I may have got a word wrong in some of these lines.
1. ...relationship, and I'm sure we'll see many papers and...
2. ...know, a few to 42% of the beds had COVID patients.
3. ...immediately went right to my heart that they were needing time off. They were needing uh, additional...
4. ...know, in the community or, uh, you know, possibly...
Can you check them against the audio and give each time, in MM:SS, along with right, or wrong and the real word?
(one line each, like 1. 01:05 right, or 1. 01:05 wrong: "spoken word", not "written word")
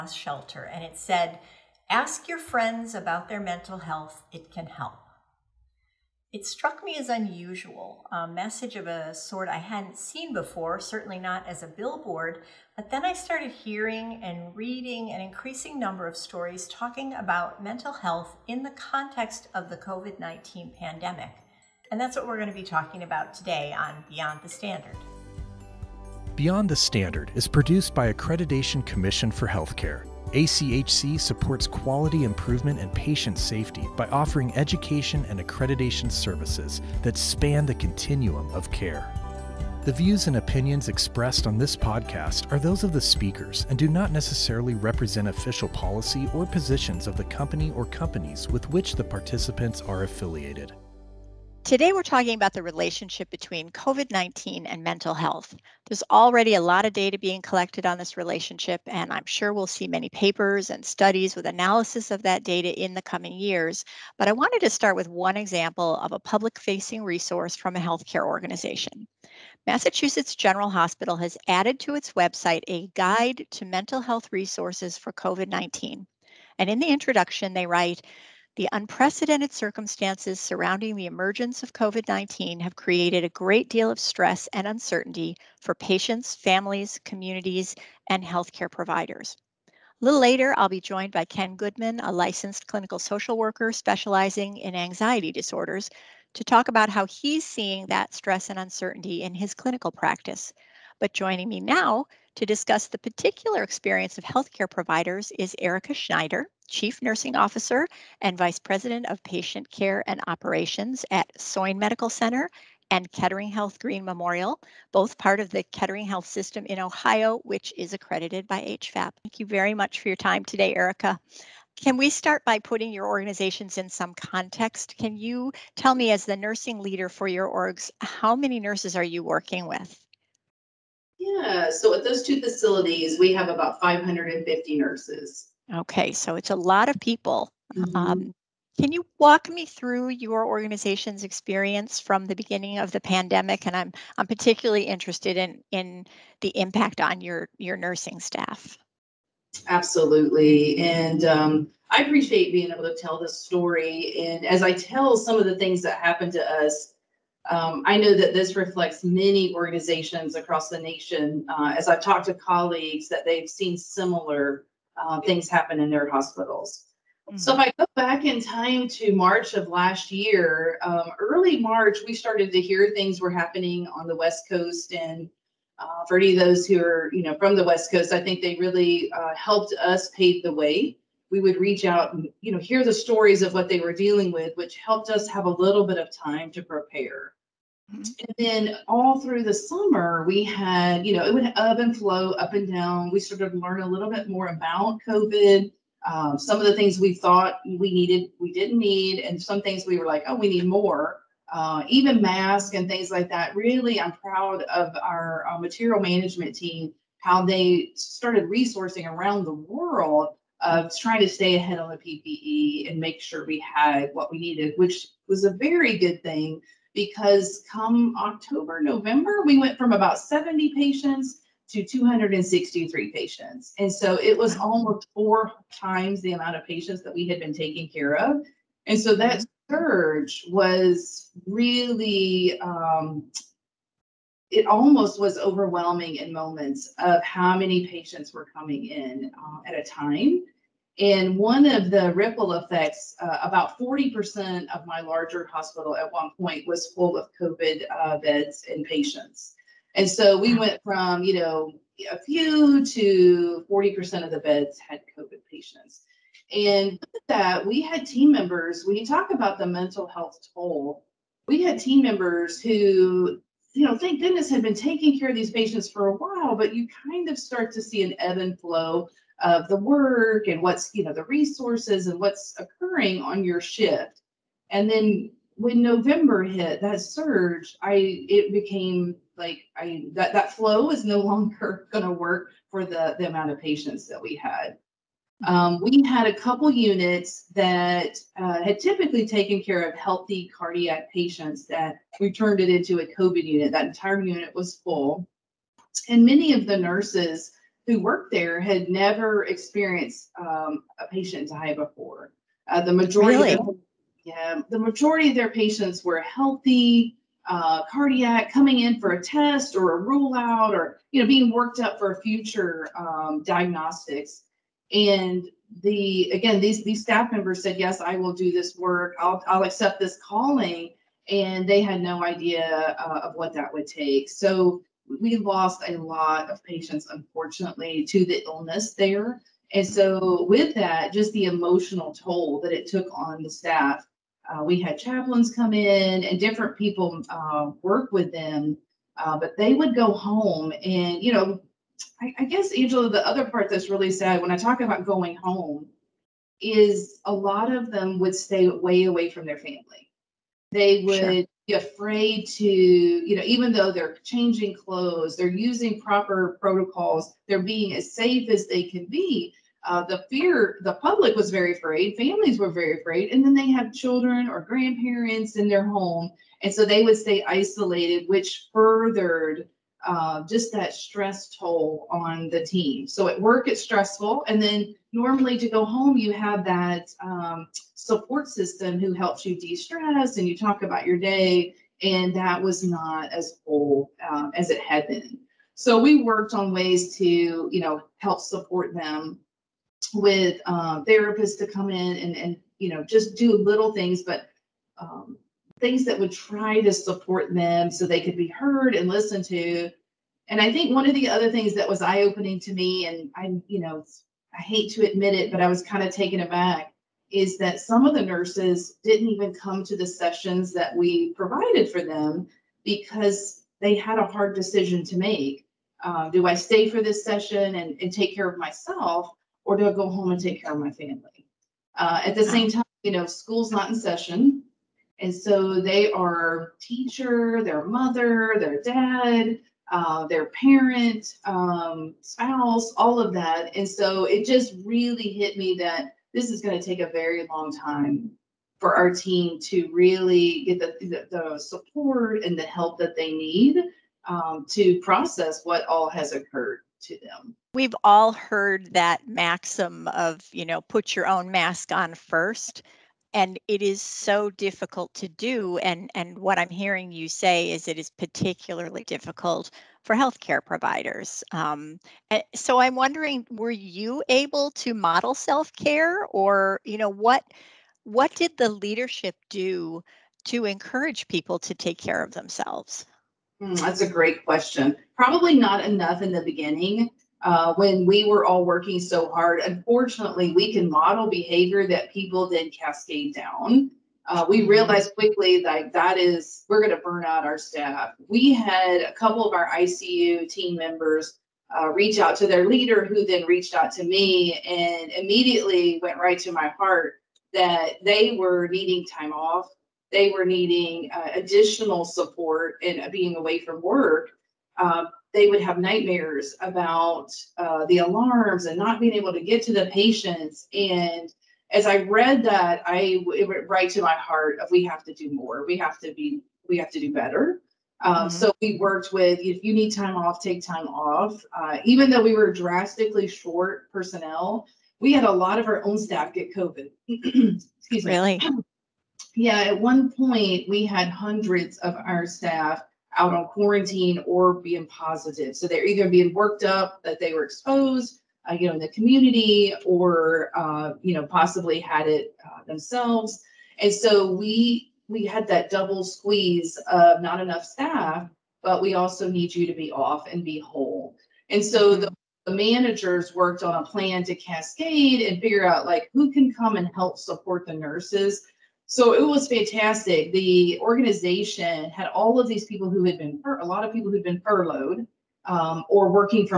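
1. 00:58 right
2. 04:11 wrong: "40", not "42"
3. 08:15 right
4. 08:58 right.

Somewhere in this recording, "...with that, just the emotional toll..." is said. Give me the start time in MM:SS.
05:30.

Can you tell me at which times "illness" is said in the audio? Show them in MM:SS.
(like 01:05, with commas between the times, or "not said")
05:28.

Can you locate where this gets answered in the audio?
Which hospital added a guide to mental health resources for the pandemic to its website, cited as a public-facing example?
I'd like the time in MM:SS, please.
01:09.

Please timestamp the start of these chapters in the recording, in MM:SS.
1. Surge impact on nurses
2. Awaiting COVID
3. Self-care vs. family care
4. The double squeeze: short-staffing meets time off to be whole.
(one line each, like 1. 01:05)
1. 04:14
2. 02:34
3. 06:44
4. 09:04.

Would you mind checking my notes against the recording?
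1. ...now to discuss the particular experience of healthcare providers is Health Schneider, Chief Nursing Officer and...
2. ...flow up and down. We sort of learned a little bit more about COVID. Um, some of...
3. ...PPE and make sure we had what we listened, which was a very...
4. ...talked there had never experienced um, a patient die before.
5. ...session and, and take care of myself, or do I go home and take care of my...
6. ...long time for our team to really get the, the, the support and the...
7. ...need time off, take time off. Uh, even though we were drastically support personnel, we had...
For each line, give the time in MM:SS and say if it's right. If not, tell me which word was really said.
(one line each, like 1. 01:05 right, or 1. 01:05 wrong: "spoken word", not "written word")
1. 01:41 wrong: "Erica", not "Health"
2. 03:11 right
3. 03:31 wrong: "needed", not "listened"
4. 04:57 wrong: "worked", not "talked"
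5. 06:57 right
6. 07:17 right
7. 08:39 wrong: "short", not "support".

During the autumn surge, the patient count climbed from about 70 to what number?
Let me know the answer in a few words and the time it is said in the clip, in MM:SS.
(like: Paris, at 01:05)
263, at 03:41.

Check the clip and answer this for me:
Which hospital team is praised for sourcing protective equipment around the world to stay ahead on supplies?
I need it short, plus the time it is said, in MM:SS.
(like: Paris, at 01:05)
material management team, at 03:25.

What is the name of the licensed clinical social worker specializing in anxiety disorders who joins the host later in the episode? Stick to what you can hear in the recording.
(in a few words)
Ken Goodman.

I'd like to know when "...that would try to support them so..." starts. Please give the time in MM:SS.
06:36.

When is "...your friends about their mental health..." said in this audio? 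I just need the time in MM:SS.
00:02.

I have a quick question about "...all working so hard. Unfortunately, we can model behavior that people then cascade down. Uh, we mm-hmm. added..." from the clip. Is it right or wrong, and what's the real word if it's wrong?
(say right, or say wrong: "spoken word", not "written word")
wrong: "realized", not "added".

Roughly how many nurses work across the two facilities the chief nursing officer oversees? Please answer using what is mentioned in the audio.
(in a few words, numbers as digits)
550.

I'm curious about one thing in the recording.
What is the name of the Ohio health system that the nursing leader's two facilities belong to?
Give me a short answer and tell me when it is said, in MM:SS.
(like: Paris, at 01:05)
Kettering Health System, at 01:55.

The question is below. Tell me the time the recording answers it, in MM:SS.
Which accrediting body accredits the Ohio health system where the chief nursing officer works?
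01:58.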